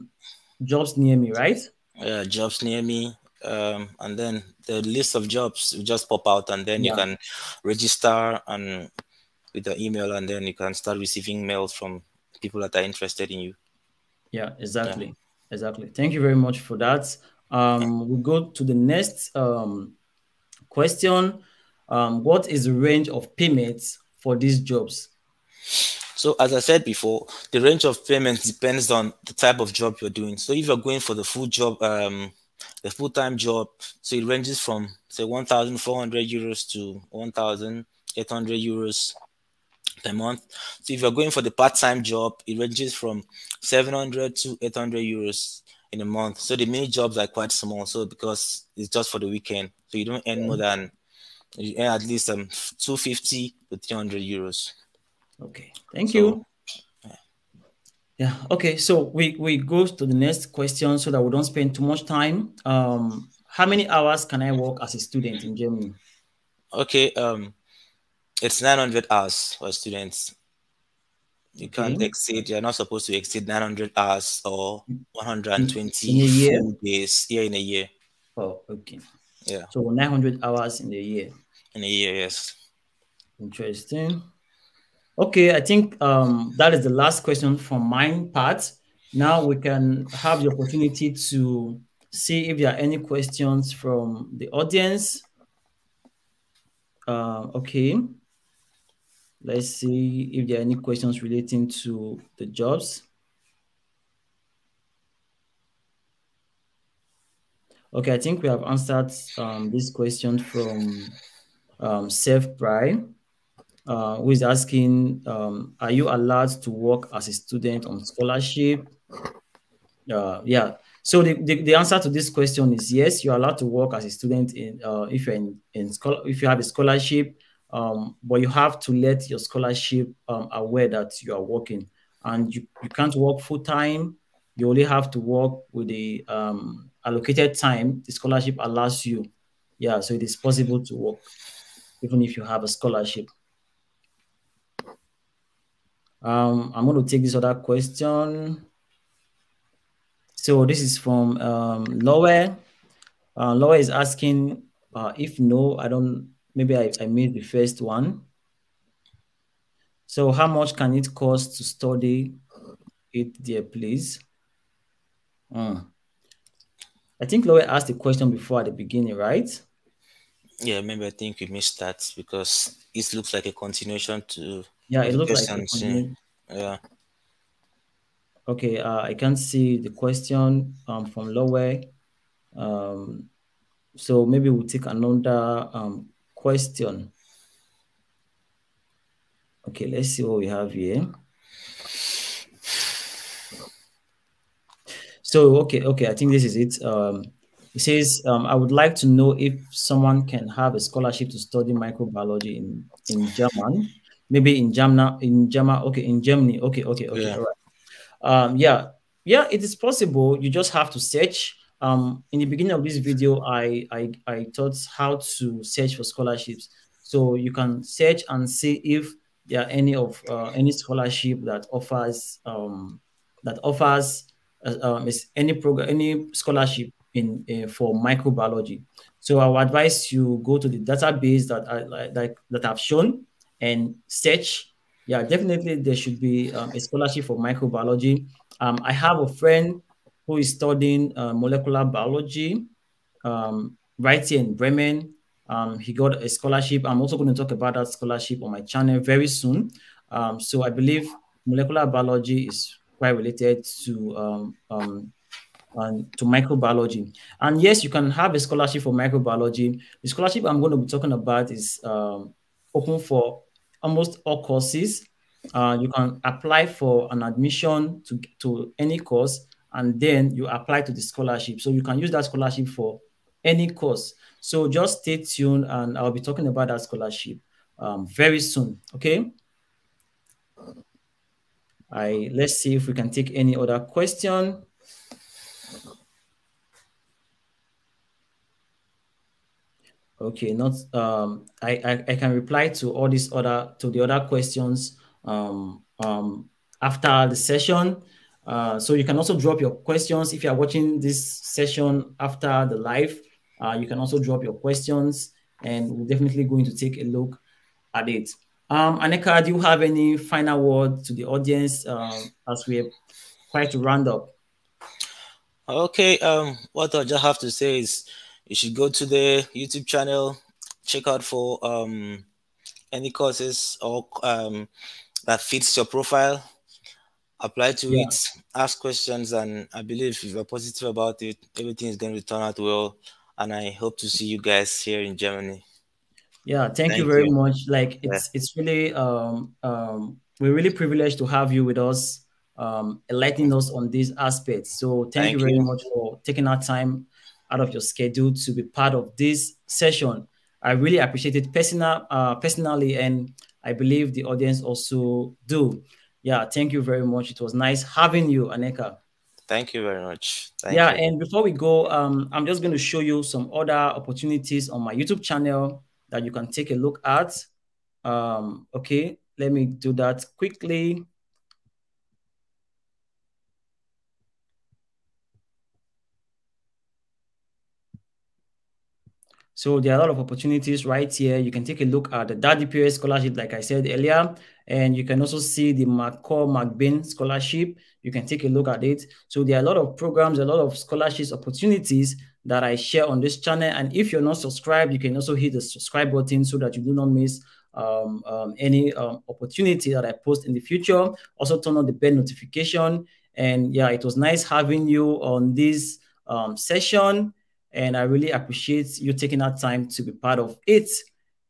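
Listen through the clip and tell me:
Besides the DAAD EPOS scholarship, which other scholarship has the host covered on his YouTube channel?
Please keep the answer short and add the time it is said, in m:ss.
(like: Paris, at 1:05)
McCall MacBain scholarship, at 6:25.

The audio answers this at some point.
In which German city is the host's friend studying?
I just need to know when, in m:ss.
4:04.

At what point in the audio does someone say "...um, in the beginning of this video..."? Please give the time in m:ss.
3:31.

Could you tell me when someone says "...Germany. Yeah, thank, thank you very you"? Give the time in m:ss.
5:35.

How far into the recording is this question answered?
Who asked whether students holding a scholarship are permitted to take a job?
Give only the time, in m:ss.
1:52.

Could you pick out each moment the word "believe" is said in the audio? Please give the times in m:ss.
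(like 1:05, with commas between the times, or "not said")
4:10, 5:29, 5:53.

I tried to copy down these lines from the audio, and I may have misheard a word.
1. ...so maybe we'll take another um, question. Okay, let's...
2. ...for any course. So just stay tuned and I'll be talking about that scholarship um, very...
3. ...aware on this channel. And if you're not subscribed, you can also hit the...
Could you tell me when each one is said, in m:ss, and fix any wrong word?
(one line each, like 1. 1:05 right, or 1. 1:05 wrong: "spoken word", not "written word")
1. 3:03 right
2. 4:32 right
3. 6:32 wrong: "share", not "aware".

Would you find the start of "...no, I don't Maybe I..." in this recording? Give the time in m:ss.
2:35.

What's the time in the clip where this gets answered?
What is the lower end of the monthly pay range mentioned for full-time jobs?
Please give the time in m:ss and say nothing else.
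0:35.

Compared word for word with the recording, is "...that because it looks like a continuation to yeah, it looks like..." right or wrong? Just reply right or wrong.
right.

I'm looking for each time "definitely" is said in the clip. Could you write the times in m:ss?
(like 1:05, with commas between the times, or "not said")
3:55, 5:06.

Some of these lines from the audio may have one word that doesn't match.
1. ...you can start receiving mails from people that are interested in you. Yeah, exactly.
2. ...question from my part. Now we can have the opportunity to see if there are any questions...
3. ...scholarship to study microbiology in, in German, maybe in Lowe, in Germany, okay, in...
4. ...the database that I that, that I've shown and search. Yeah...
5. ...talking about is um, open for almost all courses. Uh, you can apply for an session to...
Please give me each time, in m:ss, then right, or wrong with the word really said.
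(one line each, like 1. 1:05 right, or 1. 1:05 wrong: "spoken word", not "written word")
1. 0:10 right
2. 1:27 right
3. 3:20 wrong: "Germany", not "Lowe"
4. 3:50 right
5. 4:20 wrong: "admission", not "session".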